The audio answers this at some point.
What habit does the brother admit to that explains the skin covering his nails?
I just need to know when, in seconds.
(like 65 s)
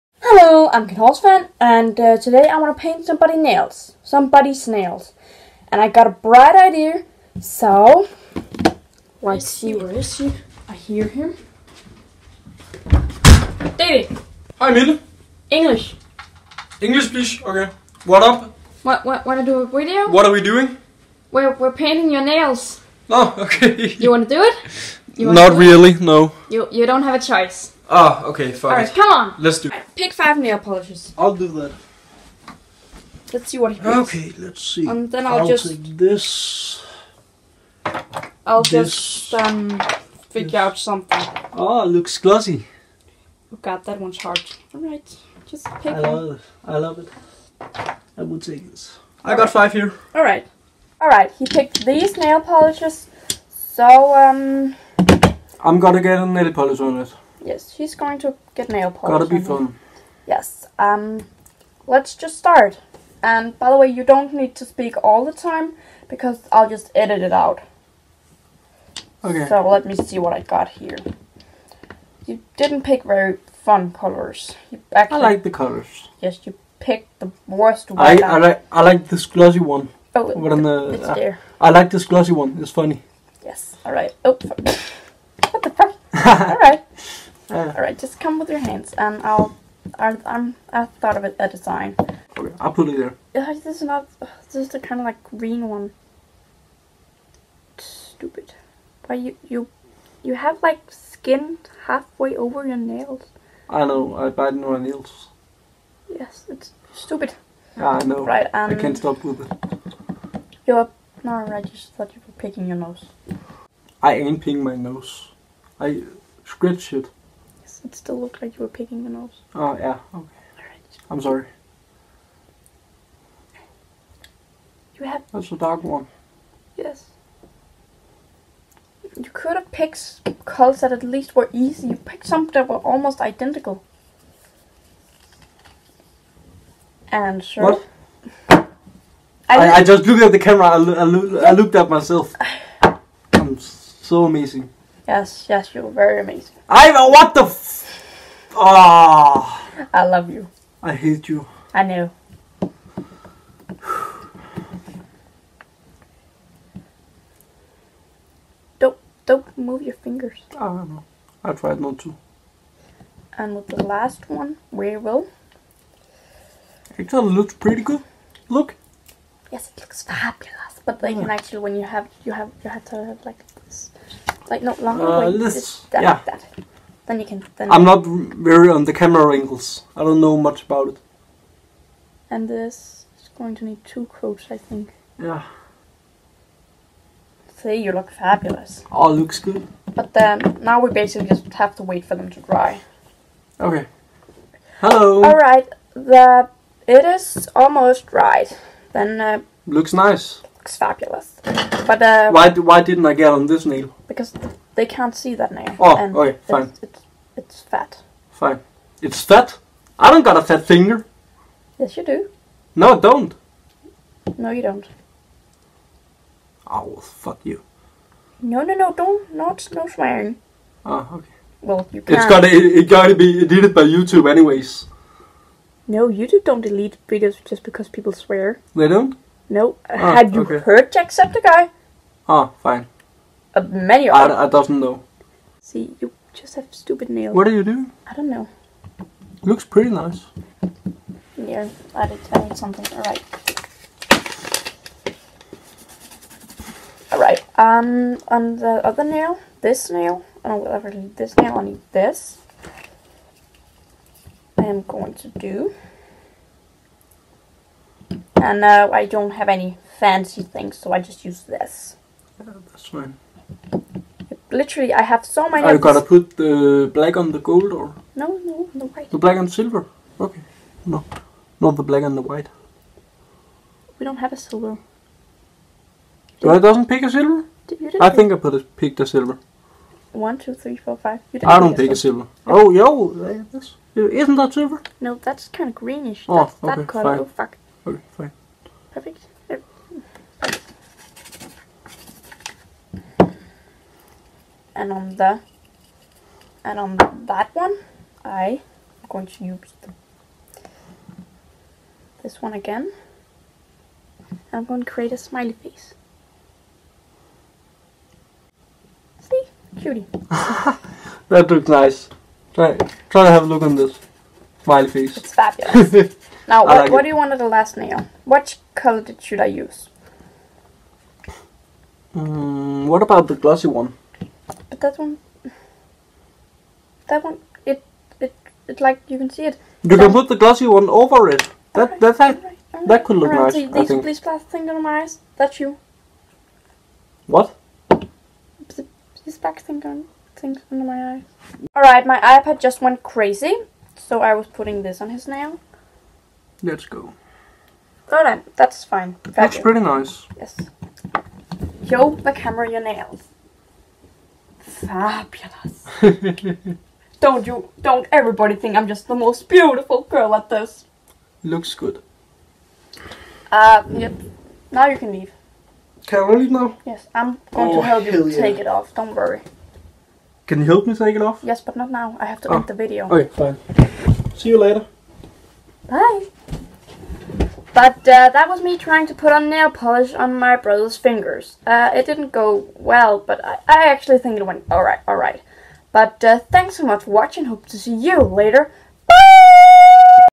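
104 s.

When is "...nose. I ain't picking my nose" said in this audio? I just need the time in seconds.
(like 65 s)
112 s.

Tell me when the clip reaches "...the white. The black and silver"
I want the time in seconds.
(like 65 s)
268 s.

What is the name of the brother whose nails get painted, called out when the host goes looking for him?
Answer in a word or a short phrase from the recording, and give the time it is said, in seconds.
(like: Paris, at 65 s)
David, at 13 s.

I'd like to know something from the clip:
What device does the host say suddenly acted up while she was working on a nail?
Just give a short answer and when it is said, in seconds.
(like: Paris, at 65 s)
iPad, at 342 s.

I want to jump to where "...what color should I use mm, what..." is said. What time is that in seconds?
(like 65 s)
318 s.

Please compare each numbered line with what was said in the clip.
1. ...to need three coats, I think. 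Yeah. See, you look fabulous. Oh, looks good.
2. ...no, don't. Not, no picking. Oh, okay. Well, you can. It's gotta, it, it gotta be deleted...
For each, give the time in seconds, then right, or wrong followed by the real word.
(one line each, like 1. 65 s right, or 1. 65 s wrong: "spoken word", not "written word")
1. 183 s wrong: "two", not "three"
2. 218 s wrong: "swearing", not "picking".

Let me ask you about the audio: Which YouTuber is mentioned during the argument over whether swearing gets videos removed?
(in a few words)
Jacksepticeye.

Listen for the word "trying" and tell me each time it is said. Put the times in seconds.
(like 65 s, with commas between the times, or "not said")
378 s.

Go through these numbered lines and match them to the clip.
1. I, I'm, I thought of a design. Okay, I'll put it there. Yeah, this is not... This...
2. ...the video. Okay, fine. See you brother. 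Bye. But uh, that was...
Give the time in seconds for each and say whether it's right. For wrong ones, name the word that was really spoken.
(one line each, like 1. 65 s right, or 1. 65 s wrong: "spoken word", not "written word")
1. 89 s right
2. 372 s wrong: "later", not "brother".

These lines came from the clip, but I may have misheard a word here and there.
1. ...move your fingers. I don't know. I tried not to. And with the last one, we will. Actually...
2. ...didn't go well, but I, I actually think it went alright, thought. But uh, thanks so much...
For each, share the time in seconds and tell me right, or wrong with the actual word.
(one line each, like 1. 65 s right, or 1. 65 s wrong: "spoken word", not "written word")
1. 159 s right
2. 382 s wrong: "alright", not "thought".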